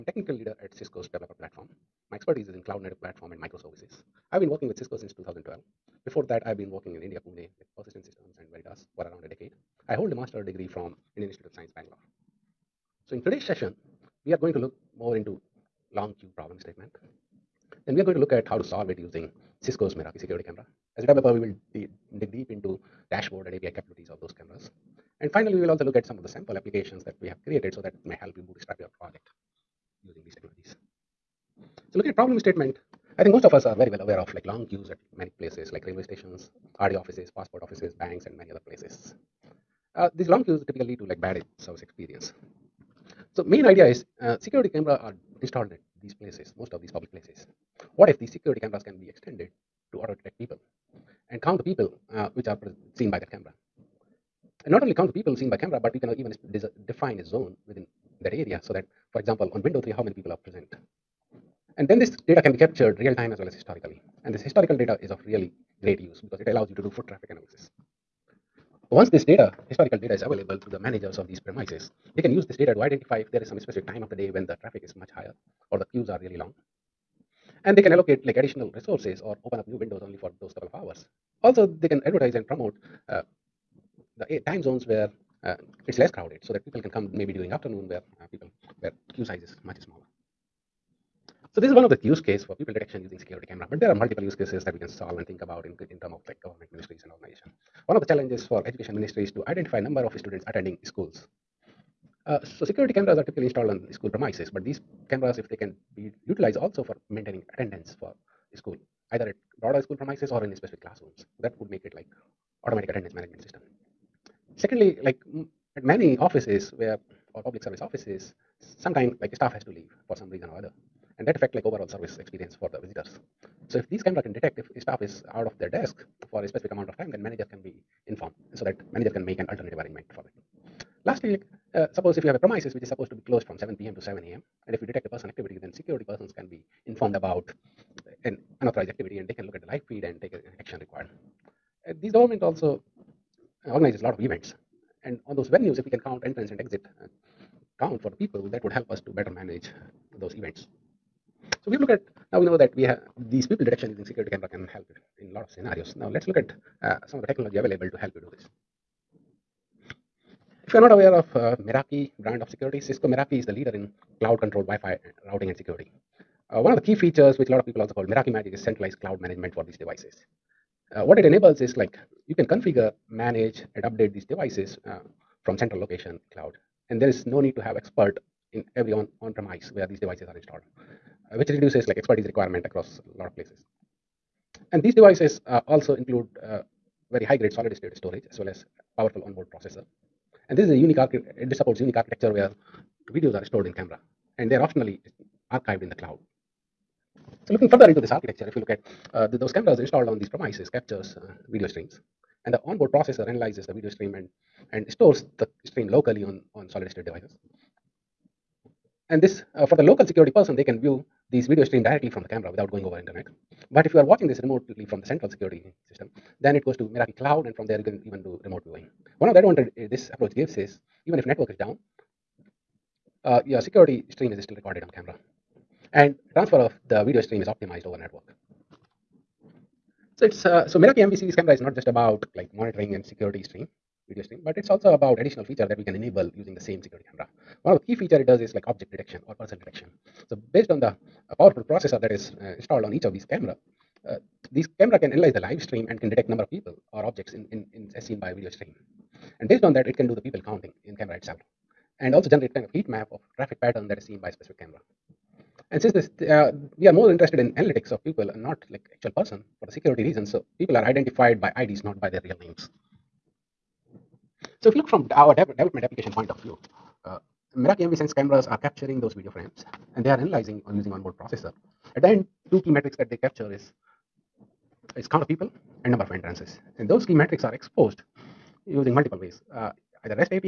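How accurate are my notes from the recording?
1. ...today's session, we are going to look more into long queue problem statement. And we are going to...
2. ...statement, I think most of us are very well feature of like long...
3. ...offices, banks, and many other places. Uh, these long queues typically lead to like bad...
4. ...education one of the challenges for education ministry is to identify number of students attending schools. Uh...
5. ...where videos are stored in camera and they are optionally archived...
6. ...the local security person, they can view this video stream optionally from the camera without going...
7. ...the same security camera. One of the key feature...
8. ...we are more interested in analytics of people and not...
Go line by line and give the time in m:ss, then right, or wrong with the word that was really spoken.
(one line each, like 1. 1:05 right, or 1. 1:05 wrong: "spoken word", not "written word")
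1. 0:13 right
2. 0:32 wrong: "aware", not "feature"
3. 0:37 right
4. 1:37 wrong: "organization", not "education"
5. 3:12 right
6. 3:29 wrong: "directly", not "optionally"
7. 3:56 right
8. 4:16 right.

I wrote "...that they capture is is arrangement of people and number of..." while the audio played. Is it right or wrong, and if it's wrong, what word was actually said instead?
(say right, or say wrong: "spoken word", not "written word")
wrong: "count", not "arrangement".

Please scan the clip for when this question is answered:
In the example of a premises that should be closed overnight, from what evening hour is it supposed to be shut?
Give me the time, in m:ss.
2:13.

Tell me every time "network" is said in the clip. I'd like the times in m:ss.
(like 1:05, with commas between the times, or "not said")
3:41, 3:47.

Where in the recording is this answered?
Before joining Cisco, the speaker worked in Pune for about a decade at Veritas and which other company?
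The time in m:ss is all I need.
0:07.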